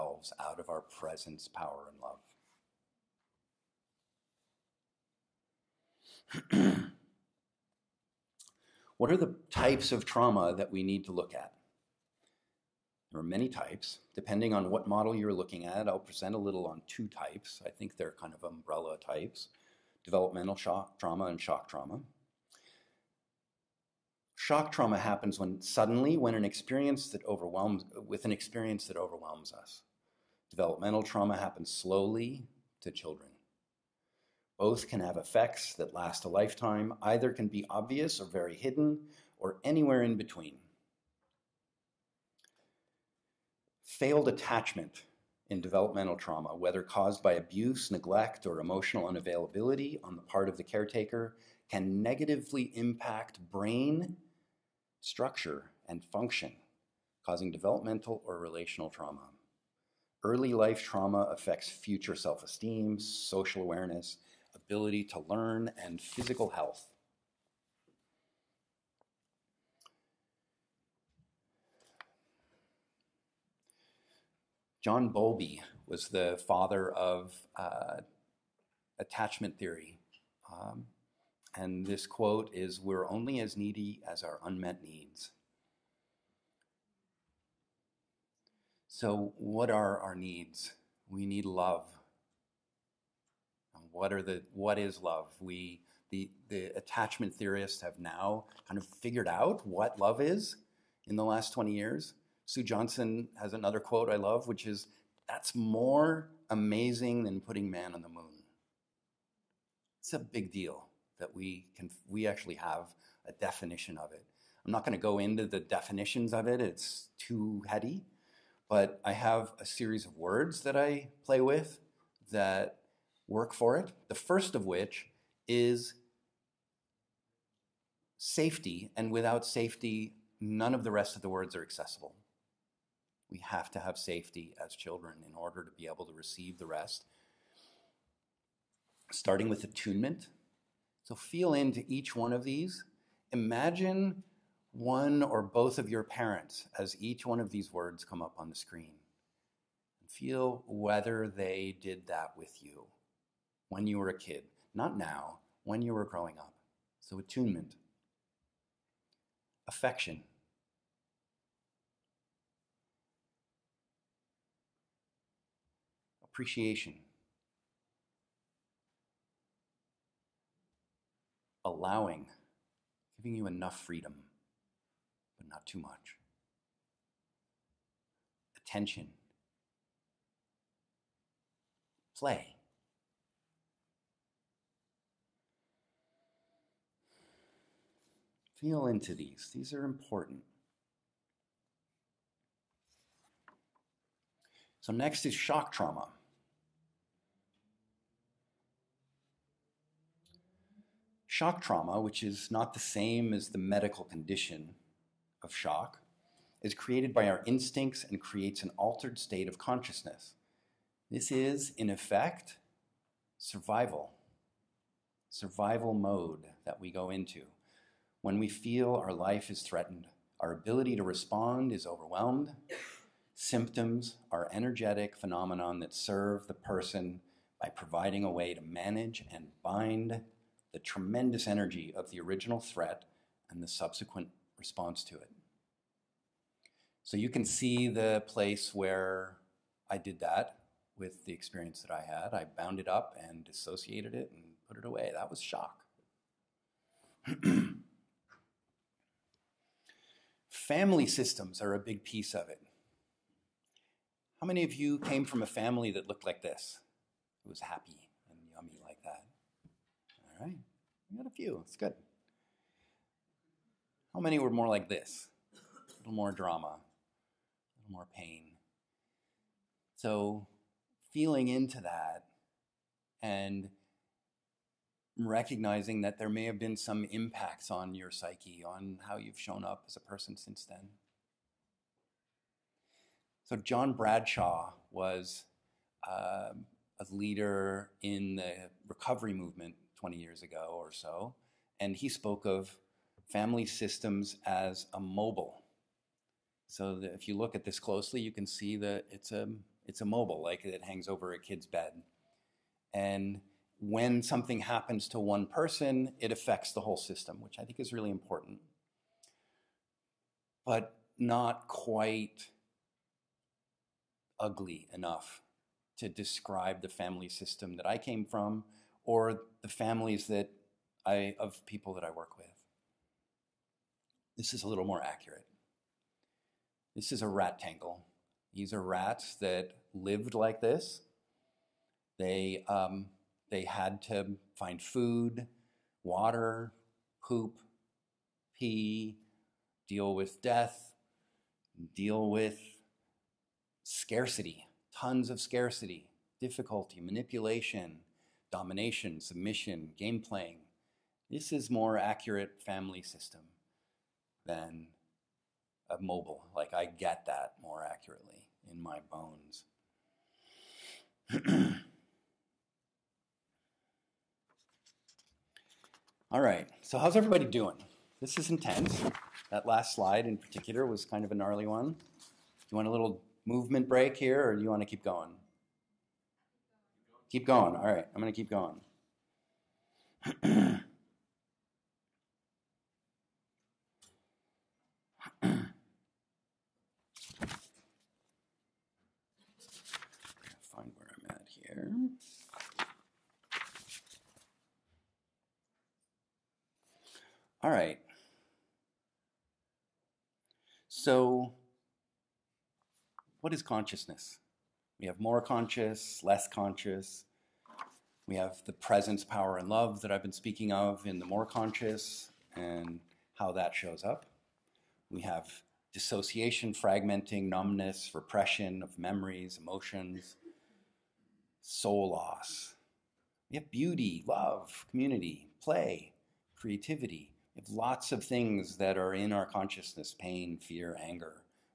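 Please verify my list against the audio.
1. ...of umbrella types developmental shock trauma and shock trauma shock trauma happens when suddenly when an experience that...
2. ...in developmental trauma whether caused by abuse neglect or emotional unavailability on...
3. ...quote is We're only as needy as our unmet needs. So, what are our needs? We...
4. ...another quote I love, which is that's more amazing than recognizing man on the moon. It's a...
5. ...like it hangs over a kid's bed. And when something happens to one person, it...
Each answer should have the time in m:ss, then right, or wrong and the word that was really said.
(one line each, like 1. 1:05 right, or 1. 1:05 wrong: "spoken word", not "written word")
1. 0:18 right
2. 0:45 right
3. 1:22 right
4. 1:43 wrong: "putting", not "recognizing"
5. 5:00 right.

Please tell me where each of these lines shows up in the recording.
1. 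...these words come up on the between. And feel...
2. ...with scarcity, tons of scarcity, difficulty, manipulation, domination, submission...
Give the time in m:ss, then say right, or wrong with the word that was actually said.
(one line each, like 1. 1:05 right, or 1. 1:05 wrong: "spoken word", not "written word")
1. 2:27 wrong: "screen", not "between"
2. 5:42 right.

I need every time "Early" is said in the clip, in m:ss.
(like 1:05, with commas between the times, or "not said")
1:00.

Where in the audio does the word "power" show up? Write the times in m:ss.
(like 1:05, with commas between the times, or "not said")
0:01, 6:49.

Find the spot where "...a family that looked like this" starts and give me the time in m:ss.
4:15.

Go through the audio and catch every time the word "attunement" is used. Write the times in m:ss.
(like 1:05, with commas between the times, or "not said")
2:19, 2:37.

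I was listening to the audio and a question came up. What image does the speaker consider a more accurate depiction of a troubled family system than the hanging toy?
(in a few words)
A rat tangle.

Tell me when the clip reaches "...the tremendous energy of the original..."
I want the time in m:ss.
3:50.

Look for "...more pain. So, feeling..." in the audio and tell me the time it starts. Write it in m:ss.
4:27.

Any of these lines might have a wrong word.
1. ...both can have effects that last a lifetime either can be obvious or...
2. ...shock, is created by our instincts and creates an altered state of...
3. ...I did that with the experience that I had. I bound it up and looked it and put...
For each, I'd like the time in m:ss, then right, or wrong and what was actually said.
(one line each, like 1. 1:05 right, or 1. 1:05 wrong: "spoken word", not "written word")
1. 0:34 right
2. 3:25 right
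3. 3:59 wrong: "dissociated", not "looked".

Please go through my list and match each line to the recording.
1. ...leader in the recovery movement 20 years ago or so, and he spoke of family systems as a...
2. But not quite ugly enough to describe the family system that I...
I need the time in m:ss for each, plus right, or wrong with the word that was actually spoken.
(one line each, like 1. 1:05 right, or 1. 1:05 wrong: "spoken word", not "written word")
1. 4:47 right
2. 5:10 right.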